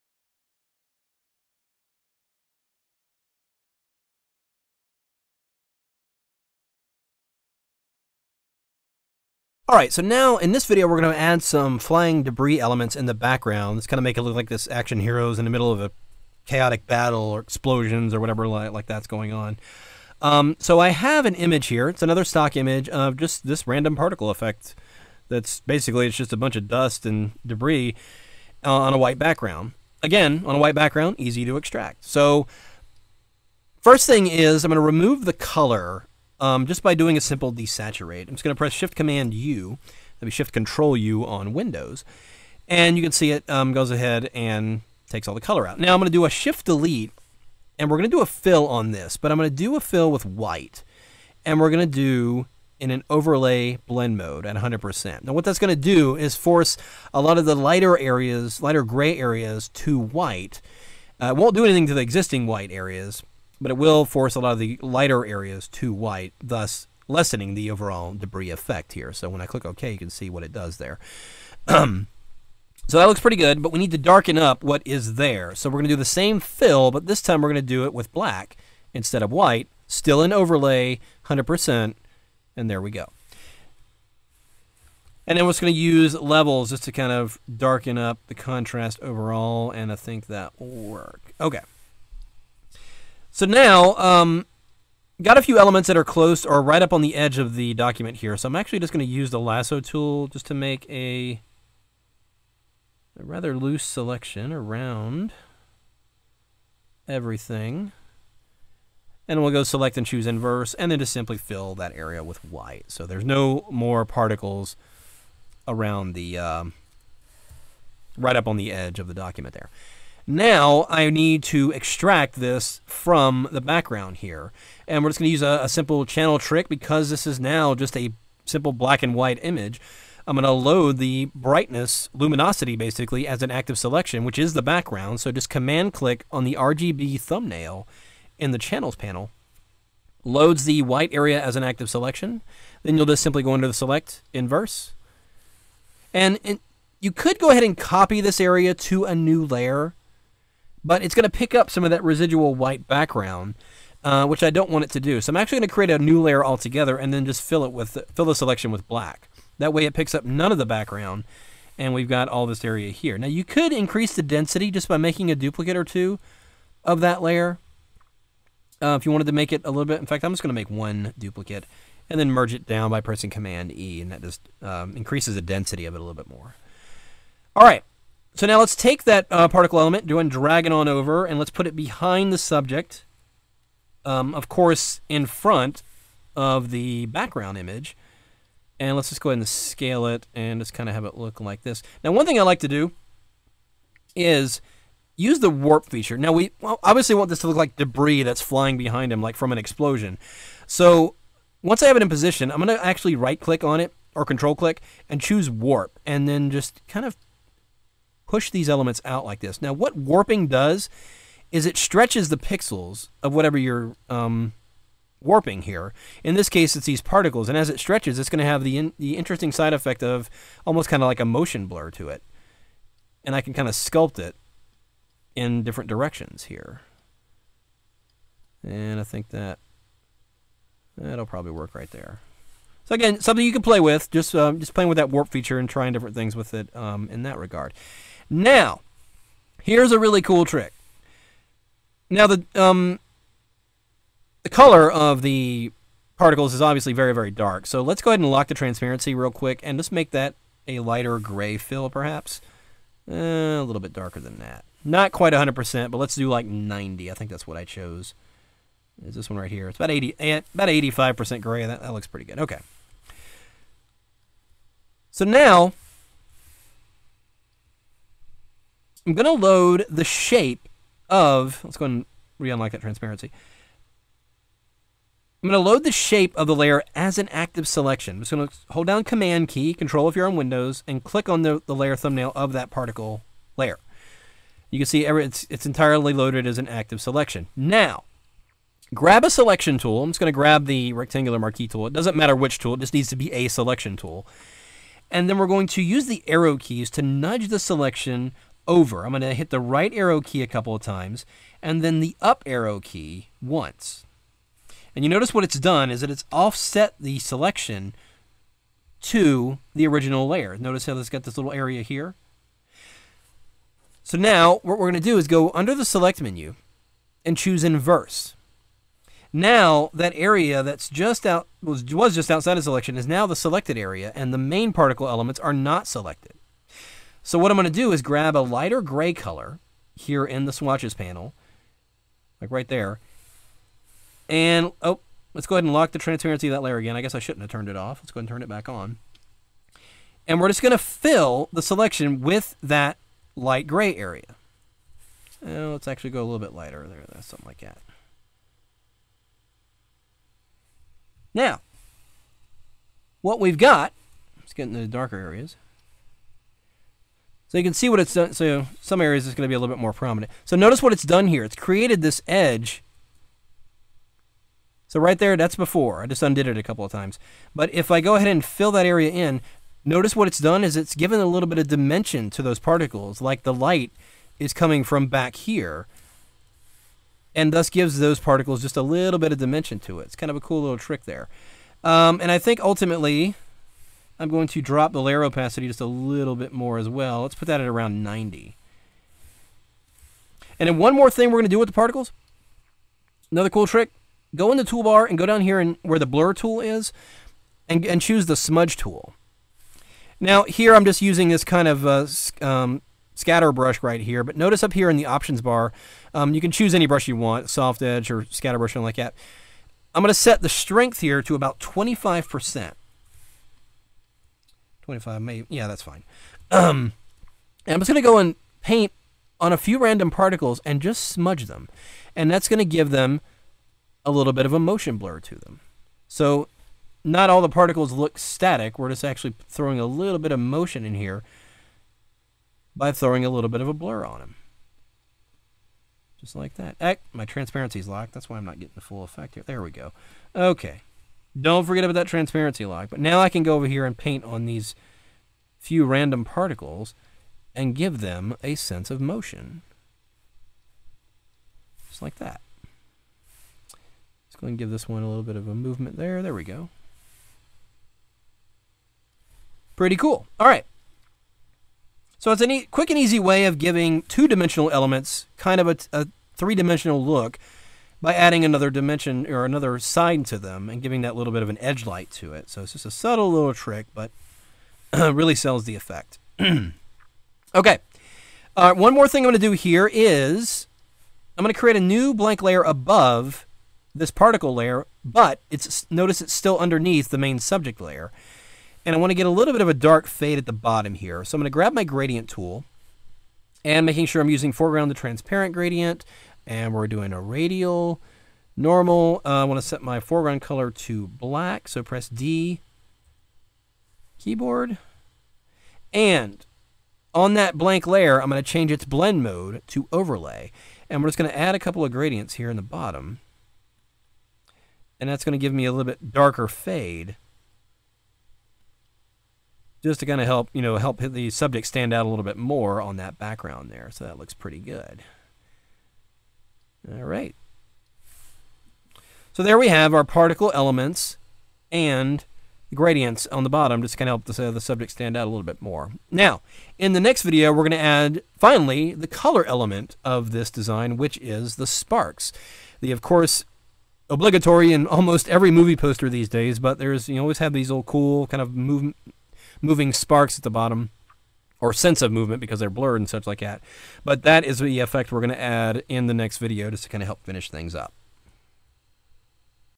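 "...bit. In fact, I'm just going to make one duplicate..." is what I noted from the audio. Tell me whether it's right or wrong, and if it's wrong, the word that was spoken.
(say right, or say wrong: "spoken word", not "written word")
right.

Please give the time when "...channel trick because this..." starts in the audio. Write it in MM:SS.
02:06.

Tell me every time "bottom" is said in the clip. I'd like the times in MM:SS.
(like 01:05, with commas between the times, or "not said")
08:10, 08:32, 08:53, 09:10.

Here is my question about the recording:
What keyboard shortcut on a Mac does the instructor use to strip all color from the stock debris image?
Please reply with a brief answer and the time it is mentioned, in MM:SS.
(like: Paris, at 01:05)
Shift Command U, at 00:38.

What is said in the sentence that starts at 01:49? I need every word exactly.
And we'll go select and choose inverse, and then just simply fill that area with white.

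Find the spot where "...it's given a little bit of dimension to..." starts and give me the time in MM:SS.
06:10.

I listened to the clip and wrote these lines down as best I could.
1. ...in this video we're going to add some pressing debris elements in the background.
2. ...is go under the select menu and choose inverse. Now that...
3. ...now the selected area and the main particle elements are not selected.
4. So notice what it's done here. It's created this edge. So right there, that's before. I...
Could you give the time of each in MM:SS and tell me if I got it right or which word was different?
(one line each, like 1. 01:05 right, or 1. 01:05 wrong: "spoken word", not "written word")
1. 00:10 wrong: "flying", not "pressing"
2. 05:15 right
3. 05:23 right
4. 06:00 right.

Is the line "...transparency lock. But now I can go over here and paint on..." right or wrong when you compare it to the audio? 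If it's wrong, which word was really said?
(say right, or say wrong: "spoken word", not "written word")
right.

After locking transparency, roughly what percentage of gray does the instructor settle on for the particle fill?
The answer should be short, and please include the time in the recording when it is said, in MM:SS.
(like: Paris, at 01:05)
85%, at 04:20.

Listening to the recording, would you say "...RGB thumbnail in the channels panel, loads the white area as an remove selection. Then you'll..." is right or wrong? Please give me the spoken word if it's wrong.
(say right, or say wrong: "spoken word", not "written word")
wrong: "active", not "remove".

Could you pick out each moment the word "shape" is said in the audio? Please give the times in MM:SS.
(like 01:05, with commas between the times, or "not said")
04:30, 04:35.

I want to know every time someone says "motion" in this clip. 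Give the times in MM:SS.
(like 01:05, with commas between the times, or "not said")
03:41, 07:04, 07:10, 07:28.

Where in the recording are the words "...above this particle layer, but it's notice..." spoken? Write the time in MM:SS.
08:02.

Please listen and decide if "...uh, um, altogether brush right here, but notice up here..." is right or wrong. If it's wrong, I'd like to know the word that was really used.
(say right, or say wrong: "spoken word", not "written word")
wrong: "scatter", not "altogether".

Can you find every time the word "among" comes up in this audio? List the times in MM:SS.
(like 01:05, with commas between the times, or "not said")
not said.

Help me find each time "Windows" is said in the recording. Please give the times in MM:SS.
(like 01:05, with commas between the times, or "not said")
00:41, 04:40.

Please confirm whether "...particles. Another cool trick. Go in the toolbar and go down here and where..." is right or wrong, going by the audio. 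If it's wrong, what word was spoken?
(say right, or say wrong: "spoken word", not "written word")
right.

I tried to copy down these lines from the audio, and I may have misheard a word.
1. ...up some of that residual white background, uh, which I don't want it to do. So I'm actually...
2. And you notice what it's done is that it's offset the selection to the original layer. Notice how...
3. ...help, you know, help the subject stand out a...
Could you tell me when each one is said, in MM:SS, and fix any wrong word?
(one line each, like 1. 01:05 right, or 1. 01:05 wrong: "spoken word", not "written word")
1. 02:31 right
2. 05:04 right
3. 08:40 right.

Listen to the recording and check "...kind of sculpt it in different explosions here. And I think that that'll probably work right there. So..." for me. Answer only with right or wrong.
wrong.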